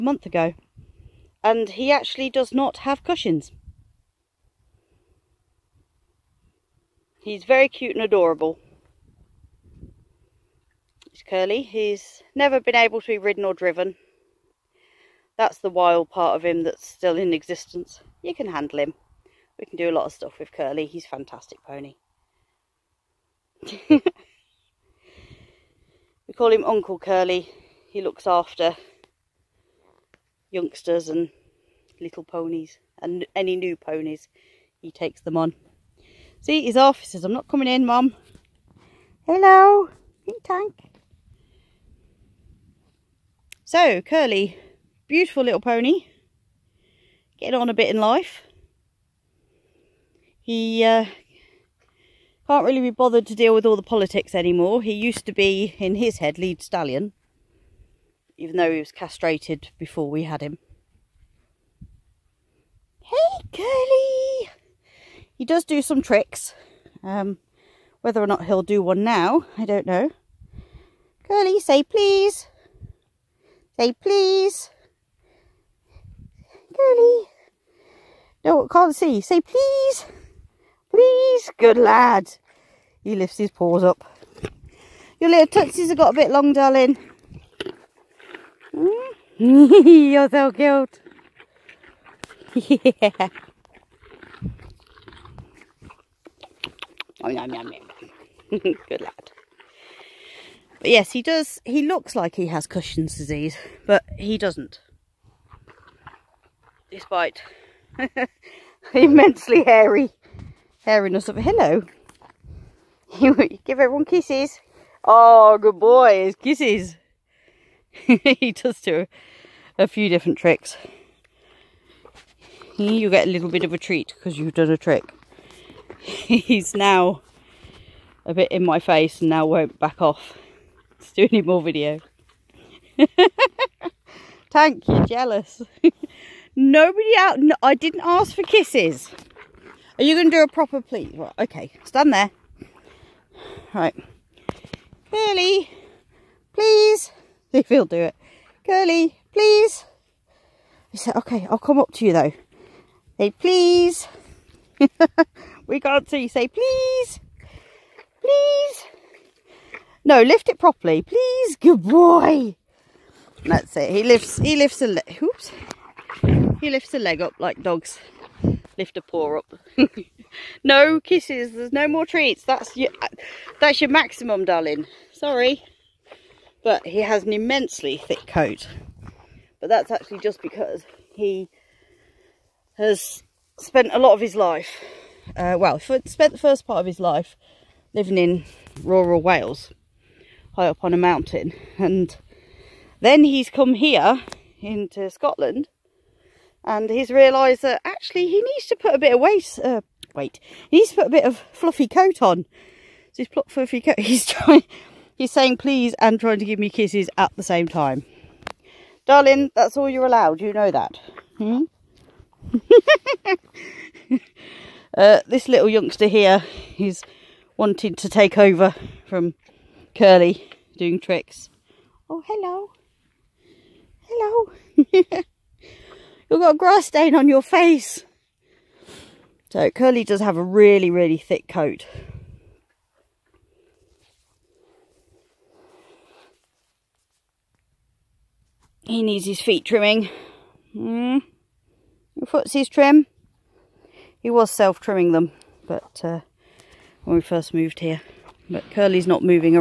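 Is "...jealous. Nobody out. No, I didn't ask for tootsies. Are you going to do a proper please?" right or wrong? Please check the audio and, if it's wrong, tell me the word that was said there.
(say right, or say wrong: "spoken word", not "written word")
wrong: "kisses", not "tootsies".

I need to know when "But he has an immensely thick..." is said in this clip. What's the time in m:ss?
2:56.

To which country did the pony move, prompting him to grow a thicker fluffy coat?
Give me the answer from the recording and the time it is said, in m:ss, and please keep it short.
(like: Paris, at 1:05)
Scotland, at 3:15.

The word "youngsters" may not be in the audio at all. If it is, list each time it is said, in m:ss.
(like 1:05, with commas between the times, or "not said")
0:30, 3:35.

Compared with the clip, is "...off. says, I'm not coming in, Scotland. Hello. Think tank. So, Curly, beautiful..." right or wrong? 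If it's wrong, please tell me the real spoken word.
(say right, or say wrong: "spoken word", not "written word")
wrong: "Mum", not "Scotland".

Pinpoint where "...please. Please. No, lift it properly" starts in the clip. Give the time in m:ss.
2:36.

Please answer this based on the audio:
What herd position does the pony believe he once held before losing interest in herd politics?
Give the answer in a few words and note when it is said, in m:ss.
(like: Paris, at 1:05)
lead stallion, at 0:56.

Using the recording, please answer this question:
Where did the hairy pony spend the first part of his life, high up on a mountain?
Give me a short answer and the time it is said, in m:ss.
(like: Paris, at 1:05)
rural Wales, at 3:08.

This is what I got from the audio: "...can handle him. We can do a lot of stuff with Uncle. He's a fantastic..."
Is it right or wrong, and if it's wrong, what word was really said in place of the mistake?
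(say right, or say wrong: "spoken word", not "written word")
wrong: "Curly", not "Uncle".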